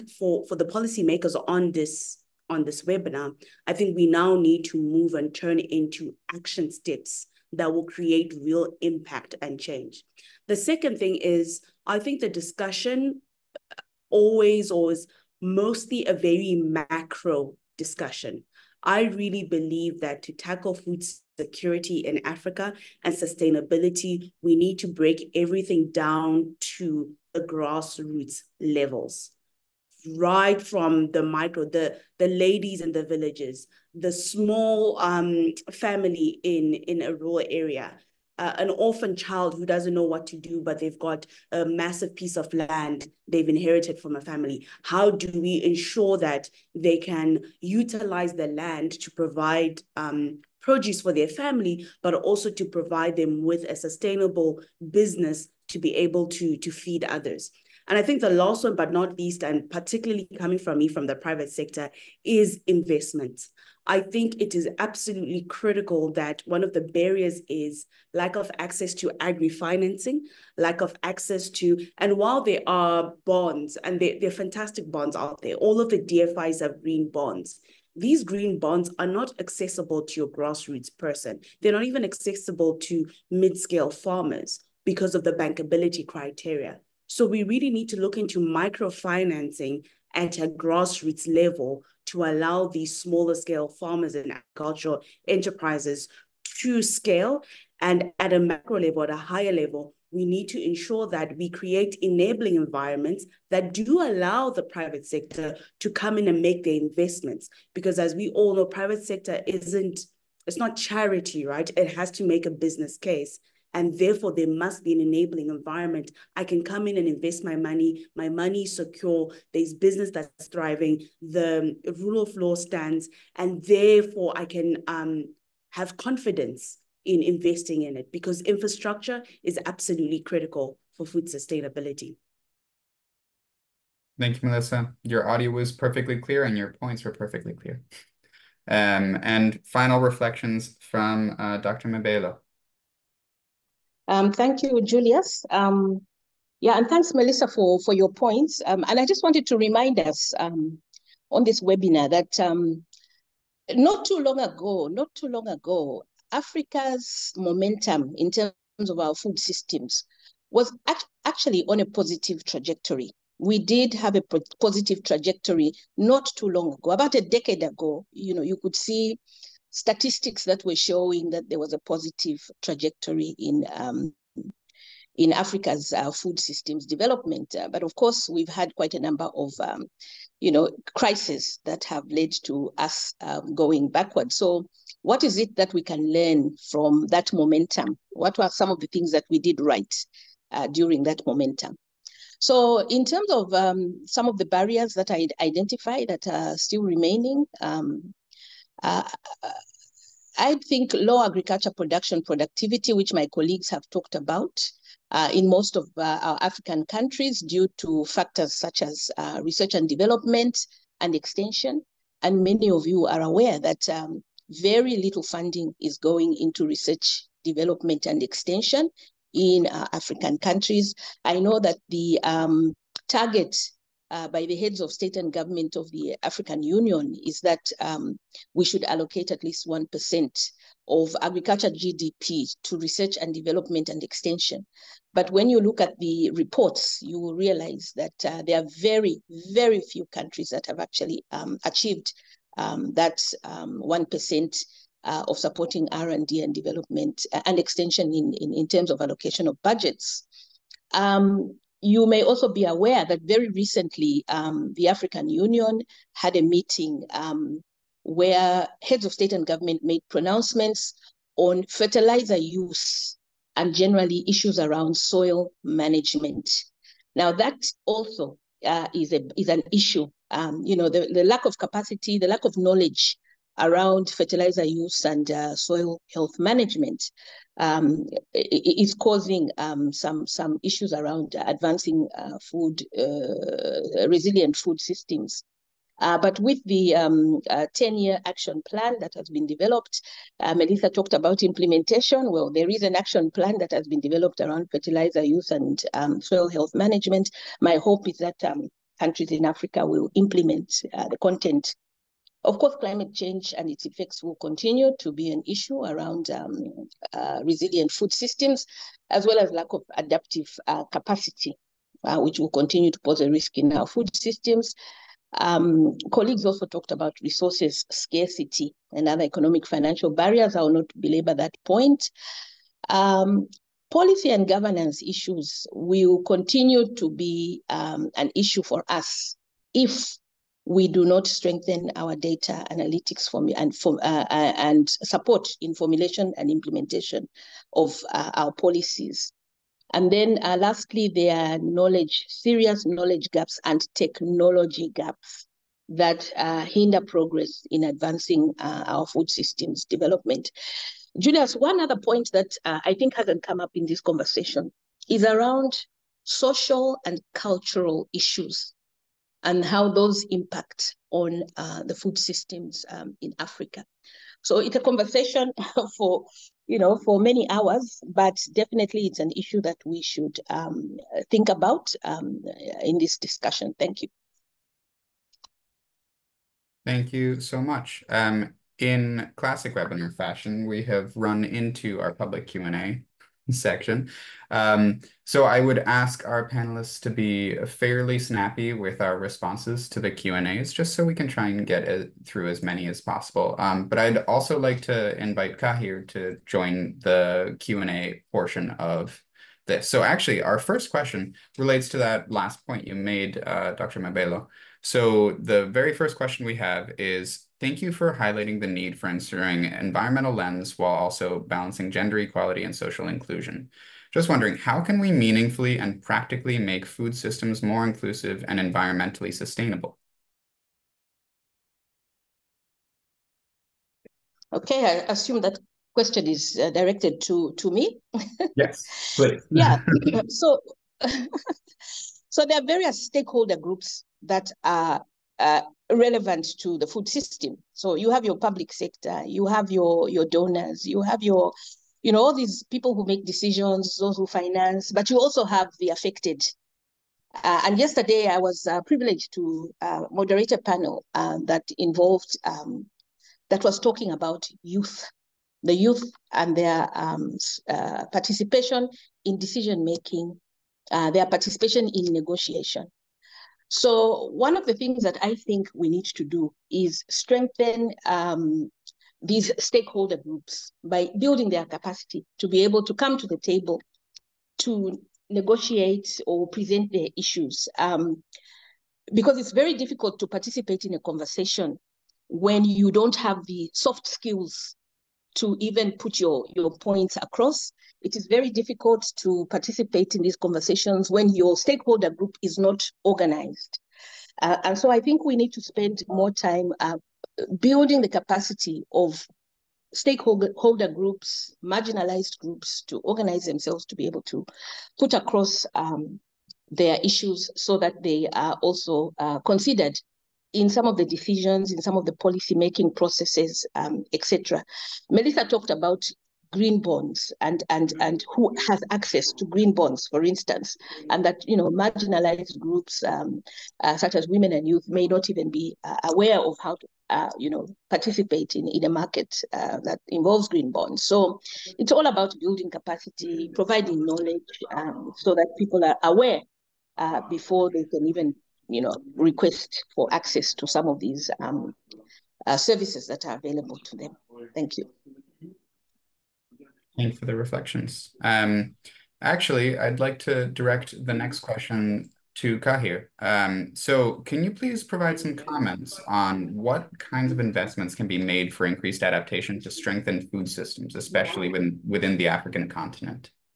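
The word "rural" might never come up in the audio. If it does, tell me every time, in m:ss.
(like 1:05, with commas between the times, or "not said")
0:37.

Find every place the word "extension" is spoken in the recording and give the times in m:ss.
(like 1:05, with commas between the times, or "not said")
3:31, 3:38, 3:54, 4:07.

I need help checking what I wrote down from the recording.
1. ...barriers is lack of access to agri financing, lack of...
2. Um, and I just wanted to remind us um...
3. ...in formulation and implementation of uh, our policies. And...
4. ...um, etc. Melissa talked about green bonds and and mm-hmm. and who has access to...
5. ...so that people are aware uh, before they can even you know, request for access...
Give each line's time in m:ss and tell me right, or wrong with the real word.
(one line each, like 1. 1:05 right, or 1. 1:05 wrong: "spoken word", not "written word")
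1. 1:06 right
2. 2:28 right
3. 5:35 right
4. 8:33 right
5. 8:55 right.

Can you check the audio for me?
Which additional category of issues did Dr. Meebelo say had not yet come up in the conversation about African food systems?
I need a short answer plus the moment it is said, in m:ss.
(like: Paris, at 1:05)
social and cultural issues, at 5:56.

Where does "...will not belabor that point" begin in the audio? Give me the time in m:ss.
5:20.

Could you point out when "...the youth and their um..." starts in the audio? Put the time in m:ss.
7:35.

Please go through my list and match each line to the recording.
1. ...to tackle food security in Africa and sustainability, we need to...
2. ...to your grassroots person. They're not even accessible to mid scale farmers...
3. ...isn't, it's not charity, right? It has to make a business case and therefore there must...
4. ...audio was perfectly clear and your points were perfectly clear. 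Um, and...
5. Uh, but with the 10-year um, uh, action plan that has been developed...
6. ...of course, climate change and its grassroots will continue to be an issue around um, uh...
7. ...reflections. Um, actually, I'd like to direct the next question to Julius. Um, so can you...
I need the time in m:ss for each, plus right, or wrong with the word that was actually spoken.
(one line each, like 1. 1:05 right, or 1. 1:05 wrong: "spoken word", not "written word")
1. 0:20 right
2. 1:20 right
3. 1:49 right
4. 2:15 right
5. 4:45 right
6. 5:02 wrong: "effects", not "grassroots"
7. 9:07 wrong: "Kahir", not "Julius".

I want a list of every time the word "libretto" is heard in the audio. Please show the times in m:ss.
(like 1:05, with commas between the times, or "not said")
not said.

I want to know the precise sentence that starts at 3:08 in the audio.
What were some of the things that we did right uh, during that momentum?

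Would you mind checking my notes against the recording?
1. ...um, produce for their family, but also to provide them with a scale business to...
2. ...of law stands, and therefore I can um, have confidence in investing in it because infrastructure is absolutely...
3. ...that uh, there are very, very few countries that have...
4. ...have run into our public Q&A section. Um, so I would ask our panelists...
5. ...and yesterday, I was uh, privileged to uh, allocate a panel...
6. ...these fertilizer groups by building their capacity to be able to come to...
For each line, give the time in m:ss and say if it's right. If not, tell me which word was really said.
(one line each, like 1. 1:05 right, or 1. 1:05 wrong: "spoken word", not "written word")
1. 0:49 wrong: "sustainable", not "scale"
2. 2:02 right
3. 3:57 right
4. 6:20 right
5. 7:27 wrong: "moderate", not "allocate"
6. 7:49 wrong: "stakeholder", not "fertilizer".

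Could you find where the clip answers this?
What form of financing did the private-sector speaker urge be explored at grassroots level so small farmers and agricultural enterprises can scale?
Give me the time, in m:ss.
1:28.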